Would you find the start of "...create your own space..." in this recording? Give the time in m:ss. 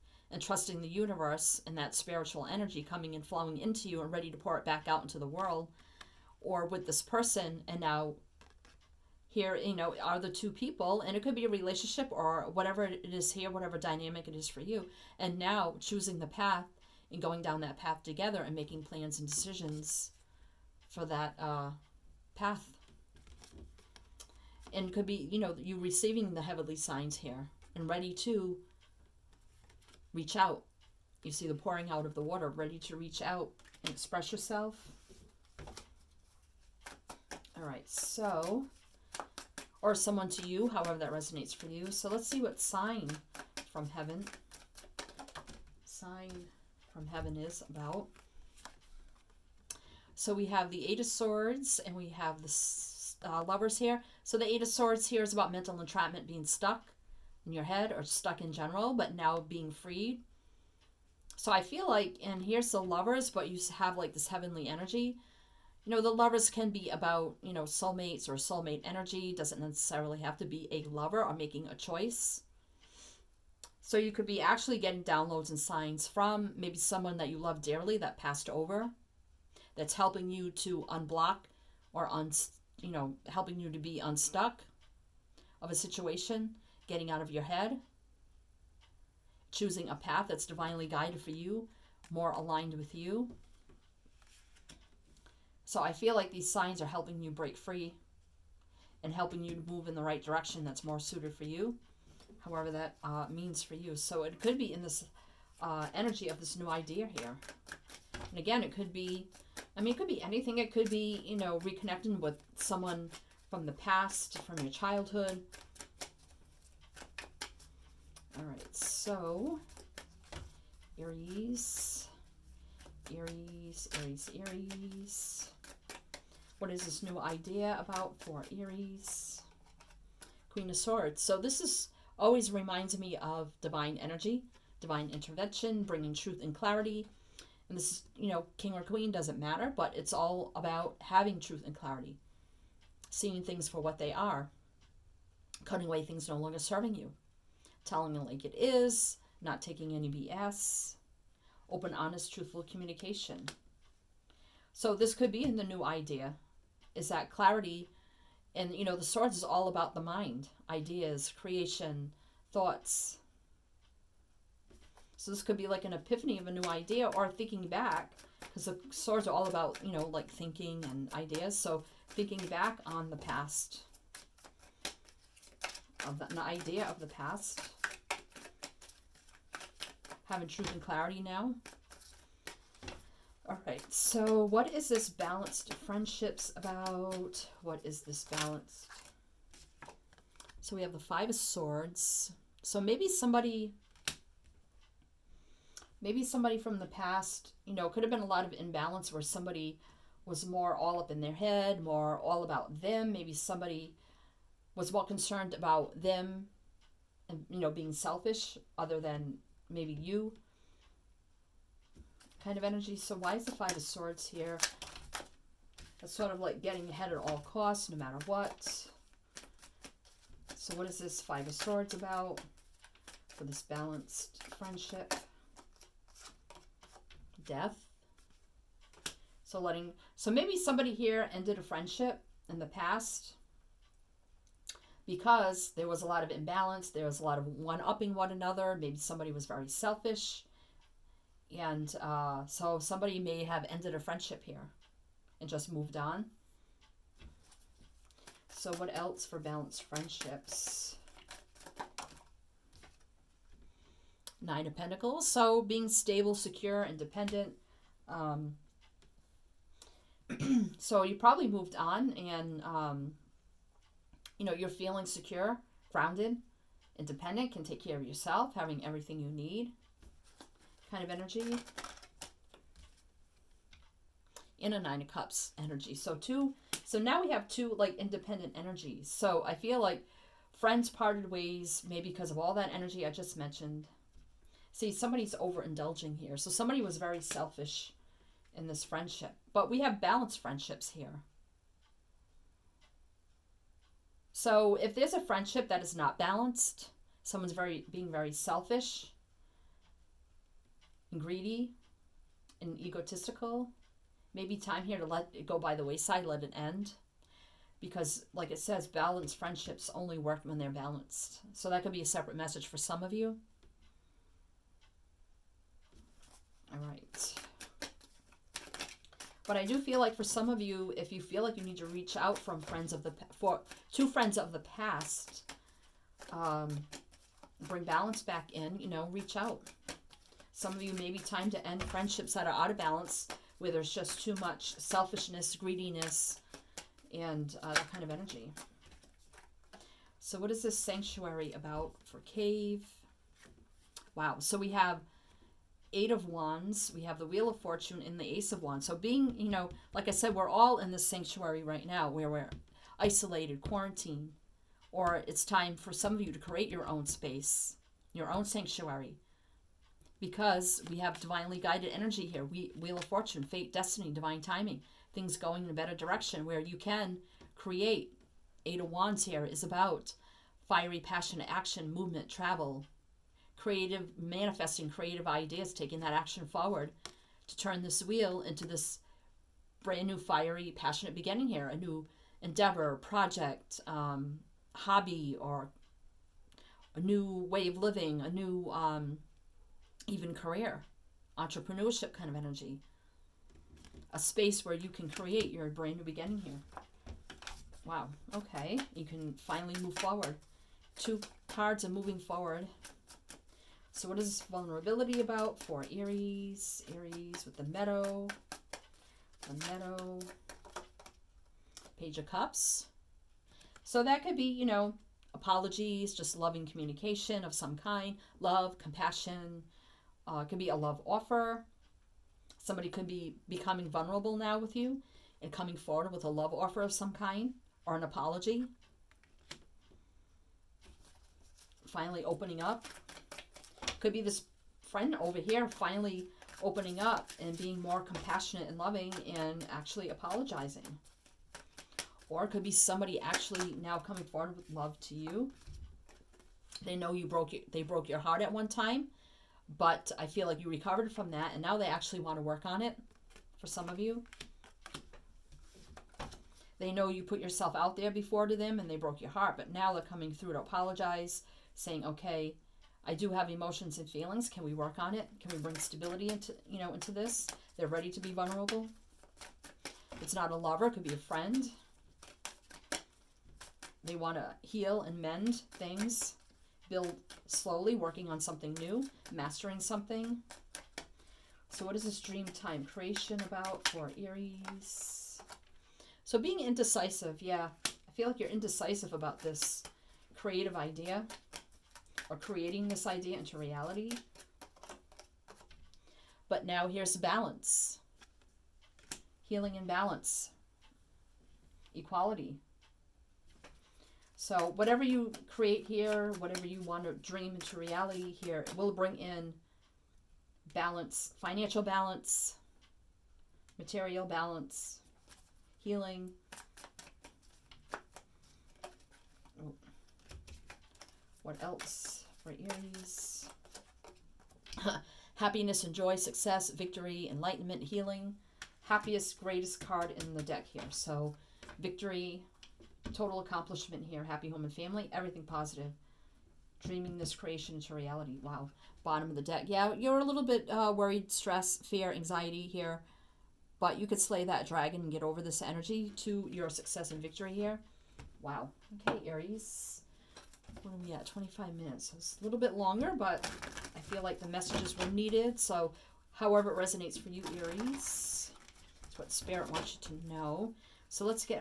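5:56.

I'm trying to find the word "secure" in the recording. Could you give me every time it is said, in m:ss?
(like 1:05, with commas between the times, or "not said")
4:16, 4:25.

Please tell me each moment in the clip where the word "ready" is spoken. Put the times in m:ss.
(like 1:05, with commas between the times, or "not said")
0:04, 0:27, 0:32, 7:47.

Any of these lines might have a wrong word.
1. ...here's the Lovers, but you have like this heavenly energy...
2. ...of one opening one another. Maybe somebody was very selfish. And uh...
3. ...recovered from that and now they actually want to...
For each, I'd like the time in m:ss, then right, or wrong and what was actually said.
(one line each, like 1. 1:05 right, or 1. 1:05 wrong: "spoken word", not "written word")
1. 1:02 right
2. 3:57 wrong: "upping", not "opening"
3. 7:30 right.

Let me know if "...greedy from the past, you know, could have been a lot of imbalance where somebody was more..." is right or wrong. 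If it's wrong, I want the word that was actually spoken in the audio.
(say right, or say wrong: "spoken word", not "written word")
wrong: "somebody", not "greedy".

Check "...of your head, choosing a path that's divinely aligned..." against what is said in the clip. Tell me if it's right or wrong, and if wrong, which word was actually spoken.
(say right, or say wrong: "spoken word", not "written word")
wrong: "guided", not "aligned".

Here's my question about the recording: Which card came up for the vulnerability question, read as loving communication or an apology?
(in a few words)
Page of Cups.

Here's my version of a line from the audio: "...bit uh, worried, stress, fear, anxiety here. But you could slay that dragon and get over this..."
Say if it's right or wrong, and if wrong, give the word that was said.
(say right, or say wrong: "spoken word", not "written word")
right.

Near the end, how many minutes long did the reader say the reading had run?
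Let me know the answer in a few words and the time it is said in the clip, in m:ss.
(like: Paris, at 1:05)
25, at 9:11.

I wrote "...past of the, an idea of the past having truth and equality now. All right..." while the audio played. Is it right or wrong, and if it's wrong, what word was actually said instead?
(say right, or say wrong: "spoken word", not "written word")
wrong: "clarity", not "equality".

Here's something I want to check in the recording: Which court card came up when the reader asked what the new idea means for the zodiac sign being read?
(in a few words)
Queen of Swords.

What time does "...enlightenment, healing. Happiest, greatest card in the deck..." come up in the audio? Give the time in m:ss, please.
8:47.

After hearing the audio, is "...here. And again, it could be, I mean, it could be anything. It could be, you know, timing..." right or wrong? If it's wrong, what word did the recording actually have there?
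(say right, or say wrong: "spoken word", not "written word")
wrong: "reconnecting", not "timing".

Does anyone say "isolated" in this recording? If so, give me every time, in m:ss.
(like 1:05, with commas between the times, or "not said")
5:52.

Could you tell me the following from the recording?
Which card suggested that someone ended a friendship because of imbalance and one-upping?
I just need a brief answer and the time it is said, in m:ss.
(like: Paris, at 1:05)
Death, at 3:47.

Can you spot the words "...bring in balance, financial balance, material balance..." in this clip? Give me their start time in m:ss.
8:28.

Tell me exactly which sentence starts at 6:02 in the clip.
We Wheel of Fortune, fate, destiny, divine timing, things going in a better direction where you can create.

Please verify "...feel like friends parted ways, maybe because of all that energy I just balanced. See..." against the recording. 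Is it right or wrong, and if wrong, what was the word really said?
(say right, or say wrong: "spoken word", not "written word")
wrong: "mentioned", not "balanced".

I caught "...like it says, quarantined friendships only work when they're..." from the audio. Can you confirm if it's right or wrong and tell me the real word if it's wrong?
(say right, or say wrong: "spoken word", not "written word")
wrong: "balanced", not "quarantined".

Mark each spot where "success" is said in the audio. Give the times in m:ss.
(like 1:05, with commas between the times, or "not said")
8:46, 9:06.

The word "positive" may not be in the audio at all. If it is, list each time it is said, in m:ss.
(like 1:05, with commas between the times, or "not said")
8:55.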